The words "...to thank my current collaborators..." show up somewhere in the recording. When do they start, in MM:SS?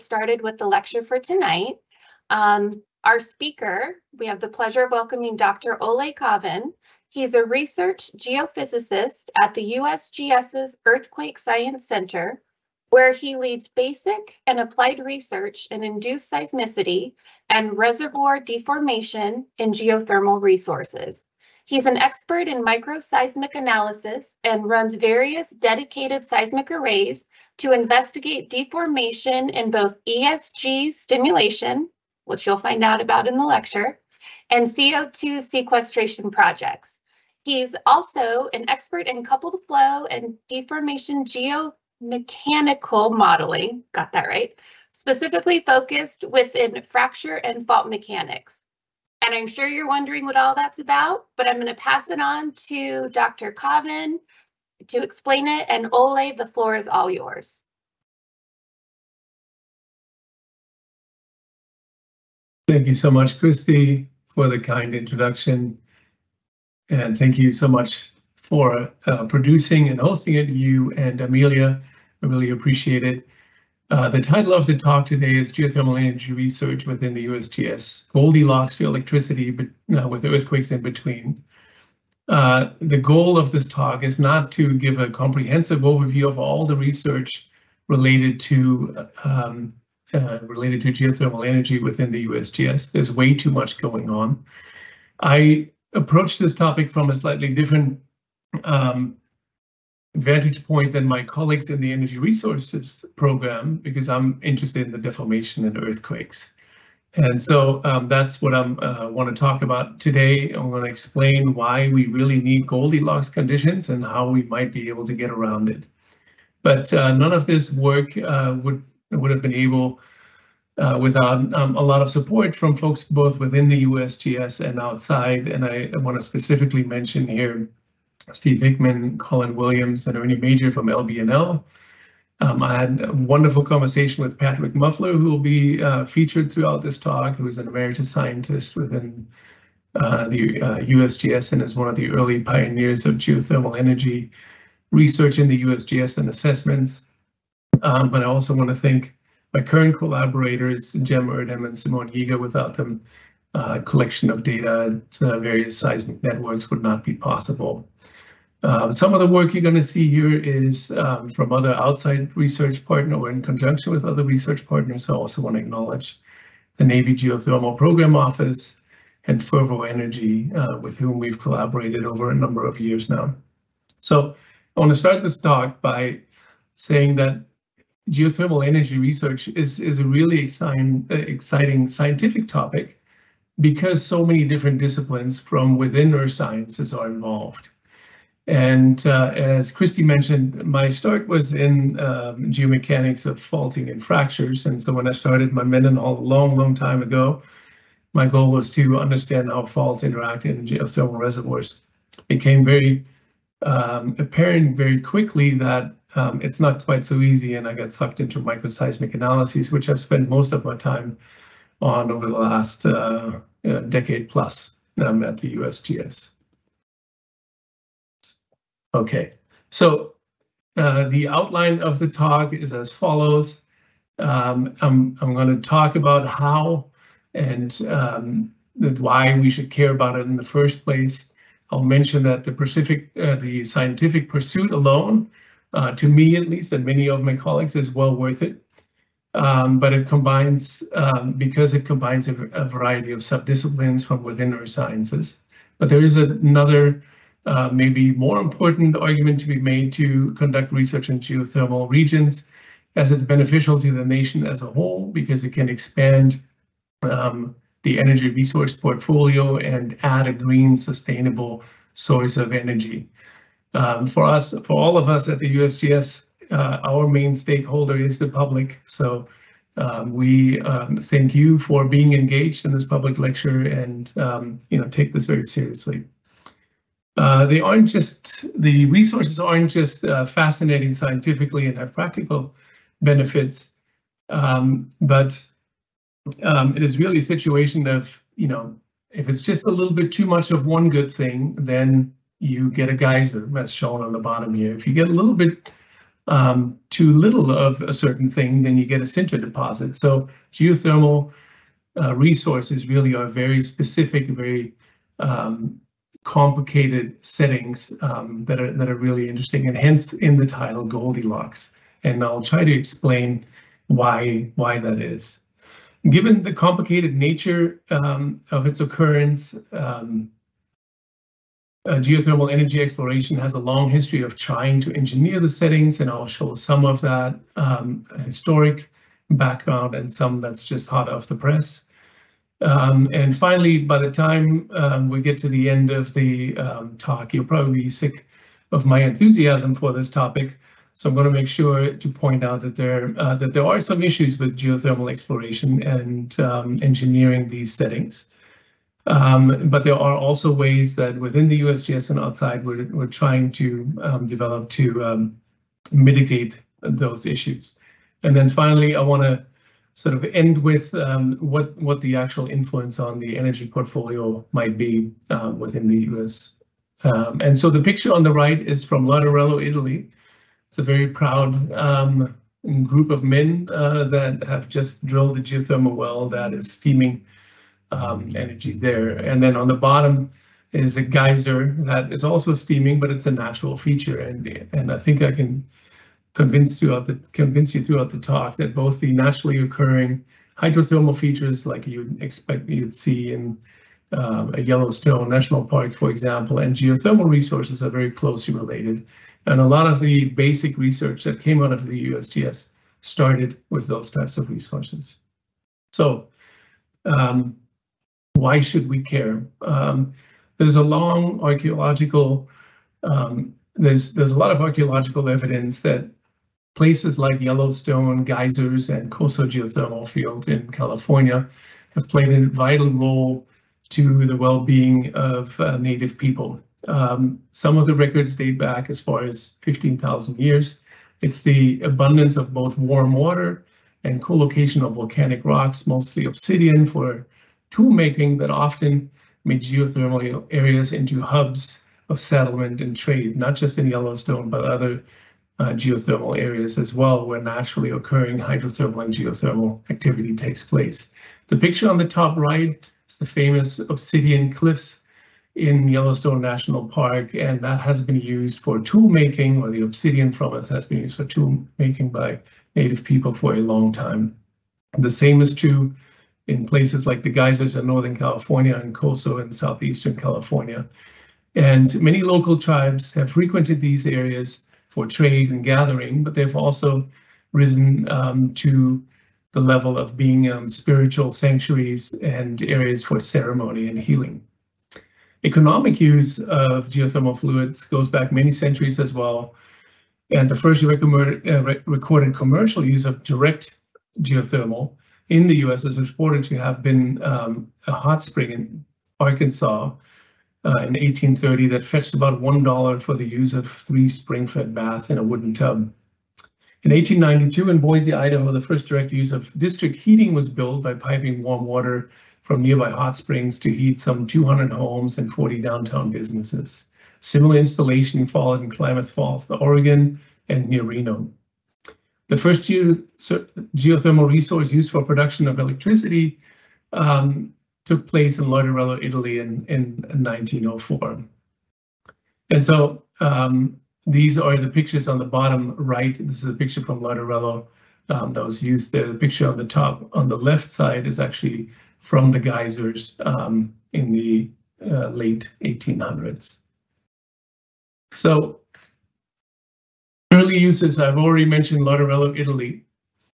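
02:28.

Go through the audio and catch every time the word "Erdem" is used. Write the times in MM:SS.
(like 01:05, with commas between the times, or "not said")
02:31.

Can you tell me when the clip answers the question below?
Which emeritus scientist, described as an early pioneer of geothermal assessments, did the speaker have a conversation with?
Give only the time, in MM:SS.
02:14.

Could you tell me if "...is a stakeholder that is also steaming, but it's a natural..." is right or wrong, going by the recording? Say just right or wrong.
wrong.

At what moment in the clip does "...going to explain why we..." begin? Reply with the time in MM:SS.
01:50.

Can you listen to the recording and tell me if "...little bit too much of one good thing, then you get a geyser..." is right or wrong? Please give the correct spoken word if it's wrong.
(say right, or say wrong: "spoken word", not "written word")
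right.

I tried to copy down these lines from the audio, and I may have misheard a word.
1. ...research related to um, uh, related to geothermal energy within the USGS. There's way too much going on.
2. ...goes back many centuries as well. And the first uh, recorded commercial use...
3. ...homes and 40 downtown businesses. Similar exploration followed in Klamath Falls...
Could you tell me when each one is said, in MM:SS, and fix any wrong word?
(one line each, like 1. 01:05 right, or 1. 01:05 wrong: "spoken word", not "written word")
1. 01:26 right
2. 08:07 right
3. 08:34 wrong: "installation", not "exploration".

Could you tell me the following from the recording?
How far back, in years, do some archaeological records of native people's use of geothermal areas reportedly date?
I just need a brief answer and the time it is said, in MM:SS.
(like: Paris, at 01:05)
15,000 years, at 07:09.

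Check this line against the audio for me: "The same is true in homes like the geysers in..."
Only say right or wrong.
wrong.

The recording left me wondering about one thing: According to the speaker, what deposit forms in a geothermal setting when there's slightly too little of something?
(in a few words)
sinter deposit.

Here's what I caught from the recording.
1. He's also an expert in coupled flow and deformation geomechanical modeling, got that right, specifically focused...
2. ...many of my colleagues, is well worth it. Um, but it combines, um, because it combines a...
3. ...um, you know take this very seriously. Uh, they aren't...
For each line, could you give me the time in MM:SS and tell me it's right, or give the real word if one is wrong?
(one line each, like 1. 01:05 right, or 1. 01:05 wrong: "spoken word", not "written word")
1. 00:37 right
2. 03:56 right
3. 04:34 right.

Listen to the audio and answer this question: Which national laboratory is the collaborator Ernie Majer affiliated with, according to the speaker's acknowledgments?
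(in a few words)
LBNL.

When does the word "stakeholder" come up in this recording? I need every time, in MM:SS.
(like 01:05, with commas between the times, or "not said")
04:27.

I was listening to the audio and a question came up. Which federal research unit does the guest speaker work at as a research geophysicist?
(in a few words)
Earthquake Science Center.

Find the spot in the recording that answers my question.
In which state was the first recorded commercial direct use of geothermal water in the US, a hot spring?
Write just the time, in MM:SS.
08:19.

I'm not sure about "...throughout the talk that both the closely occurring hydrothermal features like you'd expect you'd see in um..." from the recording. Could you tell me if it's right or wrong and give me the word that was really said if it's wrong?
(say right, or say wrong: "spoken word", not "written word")
wrong: "naturally", not "closely".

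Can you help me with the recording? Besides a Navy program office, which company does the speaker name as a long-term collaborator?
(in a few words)
Fervo Energy.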